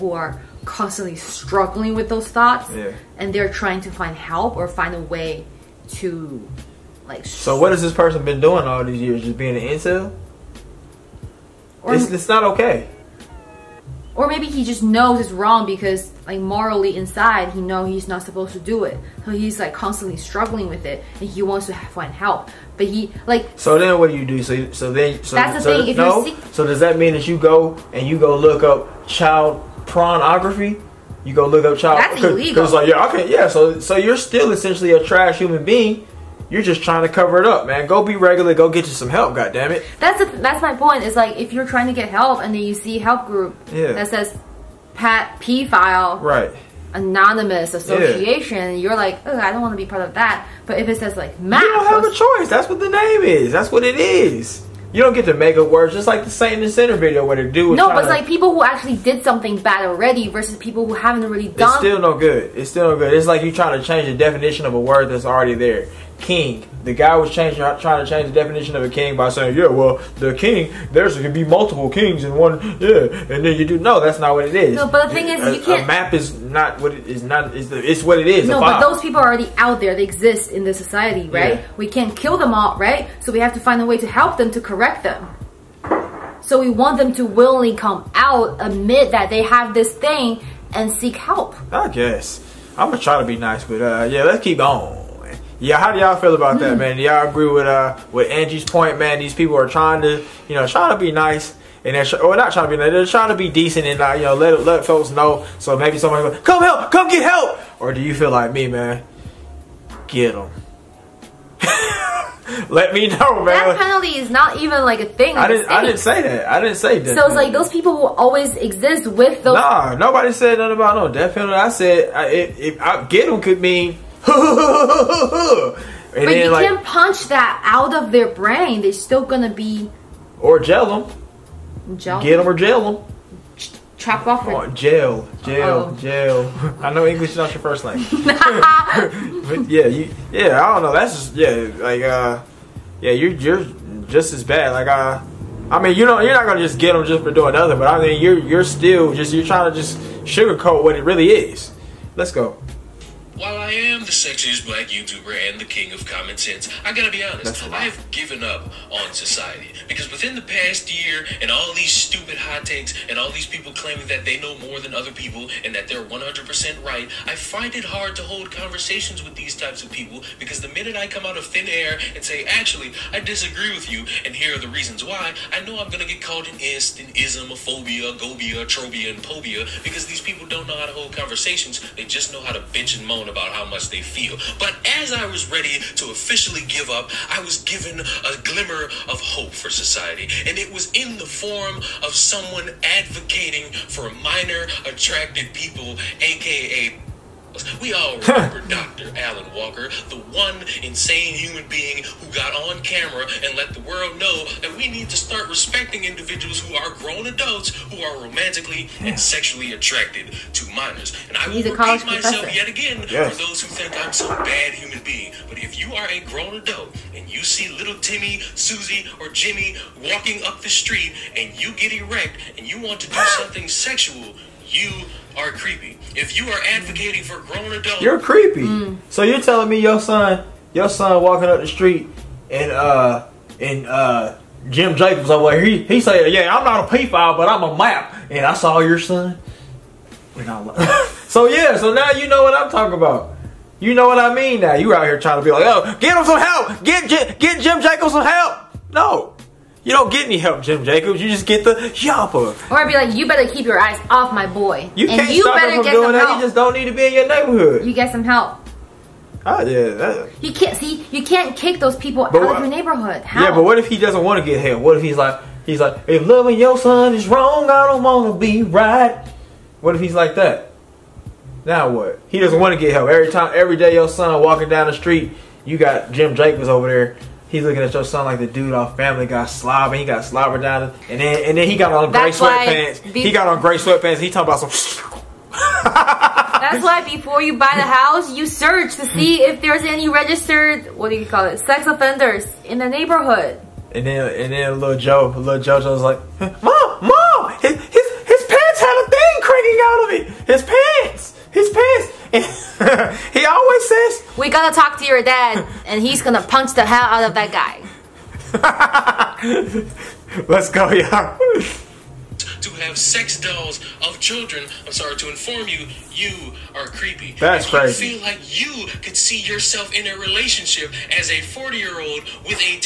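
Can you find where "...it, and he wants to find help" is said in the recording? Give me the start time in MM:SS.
00:20.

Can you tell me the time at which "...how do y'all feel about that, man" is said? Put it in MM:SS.
01:35.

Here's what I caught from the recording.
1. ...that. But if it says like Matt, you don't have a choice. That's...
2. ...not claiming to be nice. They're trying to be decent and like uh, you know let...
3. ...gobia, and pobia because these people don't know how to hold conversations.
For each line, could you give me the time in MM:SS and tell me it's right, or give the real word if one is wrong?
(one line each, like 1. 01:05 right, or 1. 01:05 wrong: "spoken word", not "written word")
1. 00:50 right
2. 01:42 wrong: "trying", not "claiming"
3. 02:58 wrong: "trobia", not "gobia".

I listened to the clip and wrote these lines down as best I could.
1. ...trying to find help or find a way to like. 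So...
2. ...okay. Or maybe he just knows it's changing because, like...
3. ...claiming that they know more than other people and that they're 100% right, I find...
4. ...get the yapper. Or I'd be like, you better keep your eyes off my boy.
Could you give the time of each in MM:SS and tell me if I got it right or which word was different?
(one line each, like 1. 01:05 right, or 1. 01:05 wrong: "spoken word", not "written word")
1. 00:03 right
2. 00:12 wrong: "wrong", not "changing"
3. 02:43 right
4. 04:11 right.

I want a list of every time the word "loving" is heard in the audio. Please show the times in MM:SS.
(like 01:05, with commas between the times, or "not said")
04:26.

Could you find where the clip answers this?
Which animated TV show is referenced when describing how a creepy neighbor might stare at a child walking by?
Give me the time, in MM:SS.
04:38.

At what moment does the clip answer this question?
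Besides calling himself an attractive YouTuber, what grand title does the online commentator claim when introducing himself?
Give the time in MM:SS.
02:35.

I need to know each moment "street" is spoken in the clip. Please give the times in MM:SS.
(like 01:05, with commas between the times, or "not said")
03:40, 03:51, 04:34.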